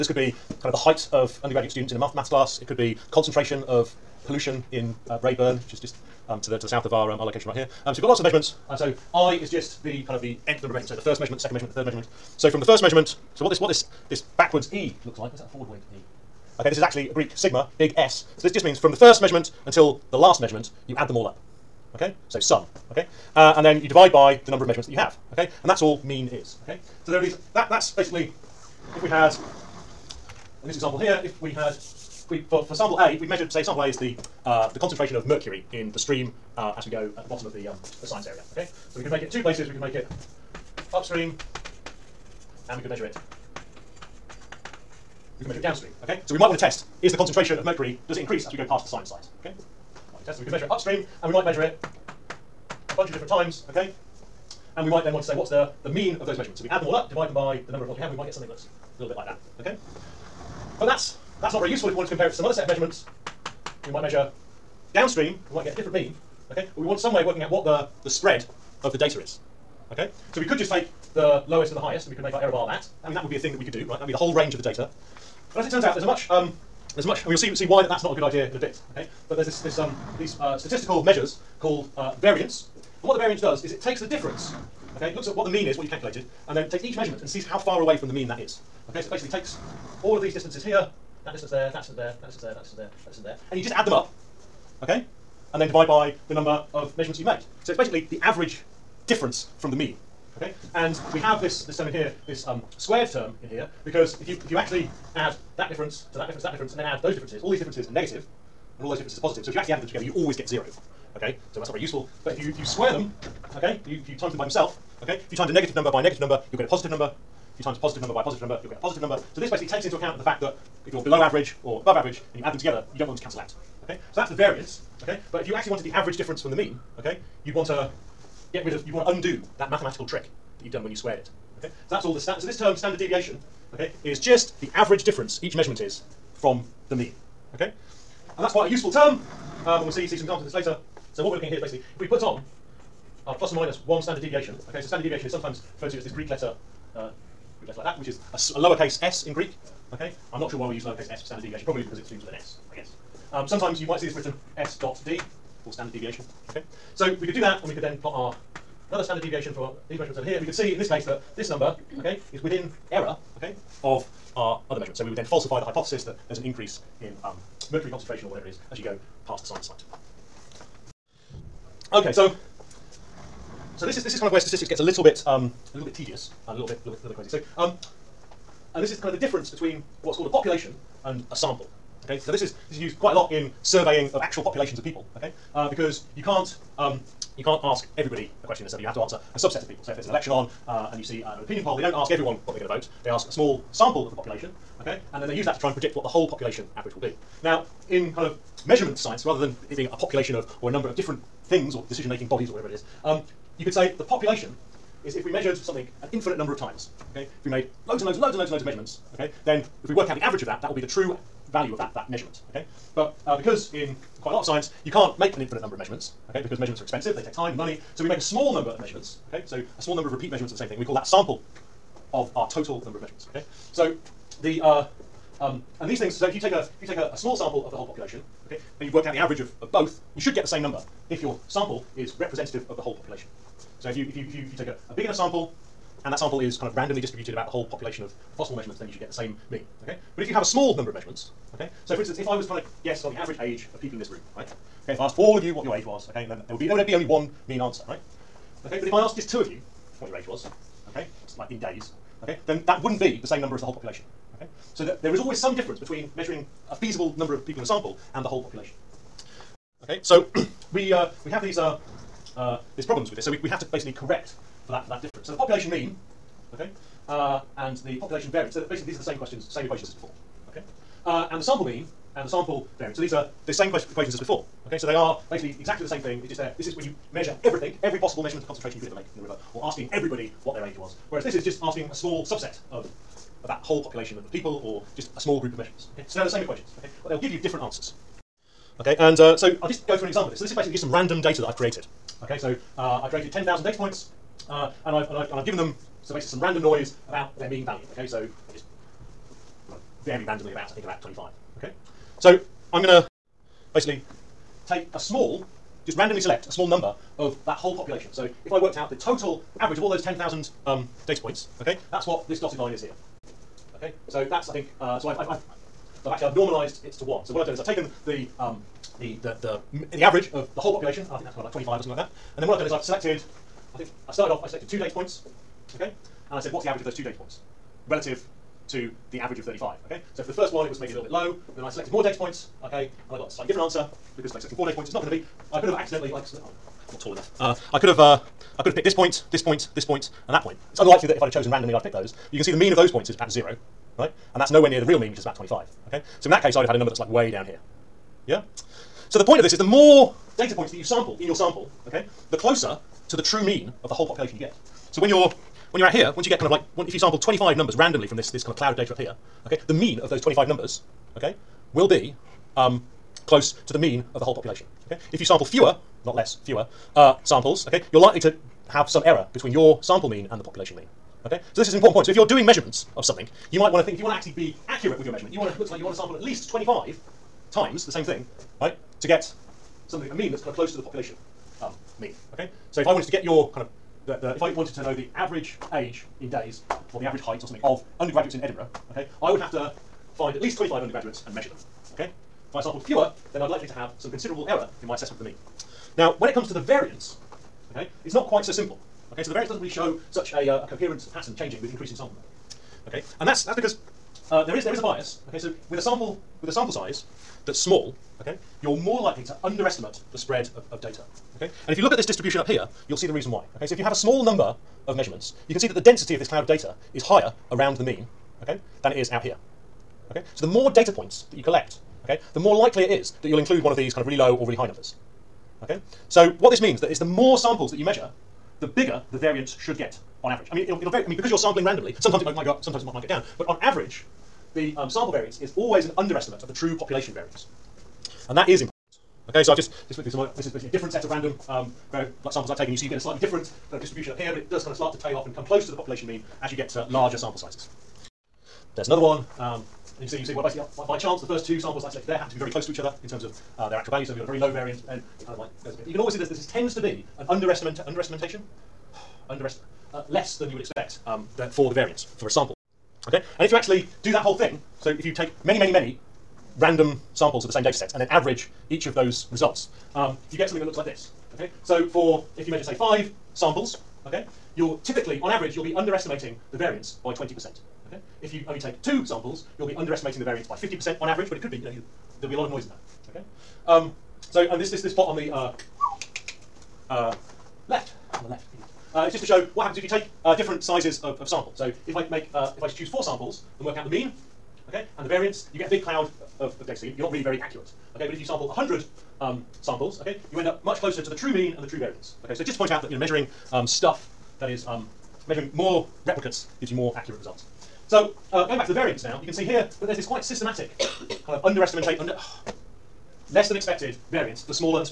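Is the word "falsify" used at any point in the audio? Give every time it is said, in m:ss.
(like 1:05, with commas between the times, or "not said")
2:45.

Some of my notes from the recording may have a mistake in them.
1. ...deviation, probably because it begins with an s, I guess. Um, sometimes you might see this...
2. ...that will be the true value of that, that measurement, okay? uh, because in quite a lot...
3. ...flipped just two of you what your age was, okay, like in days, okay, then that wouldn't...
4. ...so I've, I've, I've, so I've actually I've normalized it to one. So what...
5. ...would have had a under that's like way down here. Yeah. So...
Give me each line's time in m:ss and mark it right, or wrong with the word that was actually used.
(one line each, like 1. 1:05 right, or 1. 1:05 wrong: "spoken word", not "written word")
1. 2:31 right
2. 3:30 right
3. 4:08 wrong: "asked", not "flipped"
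4. 5:14 right
5. 5:46 wrong: "number", not "under".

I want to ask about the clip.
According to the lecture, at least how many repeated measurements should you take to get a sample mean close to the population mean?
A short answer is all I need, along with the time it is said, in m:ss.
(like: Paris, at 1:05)
25, at 6:16.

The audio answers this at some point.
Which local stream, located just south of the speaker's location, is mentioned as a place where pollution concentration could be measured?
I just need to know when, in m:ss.
0:05.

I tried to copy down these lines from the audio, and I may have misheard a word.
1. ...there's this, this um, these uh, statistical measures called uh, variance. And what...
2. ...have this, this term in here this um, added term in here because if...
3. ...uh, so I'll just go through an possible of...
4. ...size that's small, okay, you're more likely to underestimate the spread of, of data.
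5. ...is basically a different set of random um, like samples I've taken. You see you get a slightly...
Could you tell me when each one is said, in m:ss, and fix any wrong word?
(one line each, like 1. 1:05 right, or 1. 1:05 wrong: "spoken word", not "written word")
1. 1:19 right
2. 1:41 wrong: "squared", not "added"
3. 4:49 wrong: "example", not "possible"
4. 6:46 right
5. 7:20 right.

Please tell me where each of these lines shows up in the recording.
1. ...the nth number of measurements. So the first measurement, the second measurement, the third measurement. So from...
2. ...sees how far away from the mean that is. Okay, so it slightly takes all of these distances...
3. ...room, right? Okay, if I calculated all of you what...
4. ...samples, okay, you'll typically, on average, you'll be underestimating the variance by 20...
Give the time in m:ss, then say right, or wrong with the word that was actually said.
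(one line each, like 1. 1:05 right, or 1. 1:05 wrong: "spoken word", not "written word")
1. 0:10 right
2. 1:27 wrong: "basically", not "slightly"
3. 4:04 wrong: "asked", not "calculated"
4. 7:53 right.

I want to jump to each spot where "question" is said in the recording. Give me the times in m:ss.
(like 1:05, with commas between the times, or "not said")
3:08, 4:29.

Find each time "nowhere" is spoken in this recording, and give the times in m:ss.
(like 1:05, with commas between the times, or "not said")
5:44.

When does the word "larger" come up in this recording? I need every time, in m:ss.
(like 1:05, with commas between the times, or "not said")
7:26.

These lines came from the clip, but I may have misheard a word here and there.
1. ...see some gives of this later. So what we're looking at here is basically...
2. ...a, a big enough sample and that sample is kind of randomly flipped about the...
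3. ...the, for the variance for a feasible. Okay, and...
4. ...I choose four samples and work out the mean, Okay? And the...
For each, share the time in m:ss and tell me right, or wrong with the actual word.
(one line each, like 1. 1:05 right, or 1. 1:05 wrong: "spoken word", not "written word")
1. 2:20 wrong: "examples", not "gives"
2. 3:54 wrong: "distributed", not "flipped"
3. 7:41 wrong: "sample", not "feasible"
4. 8:12 right.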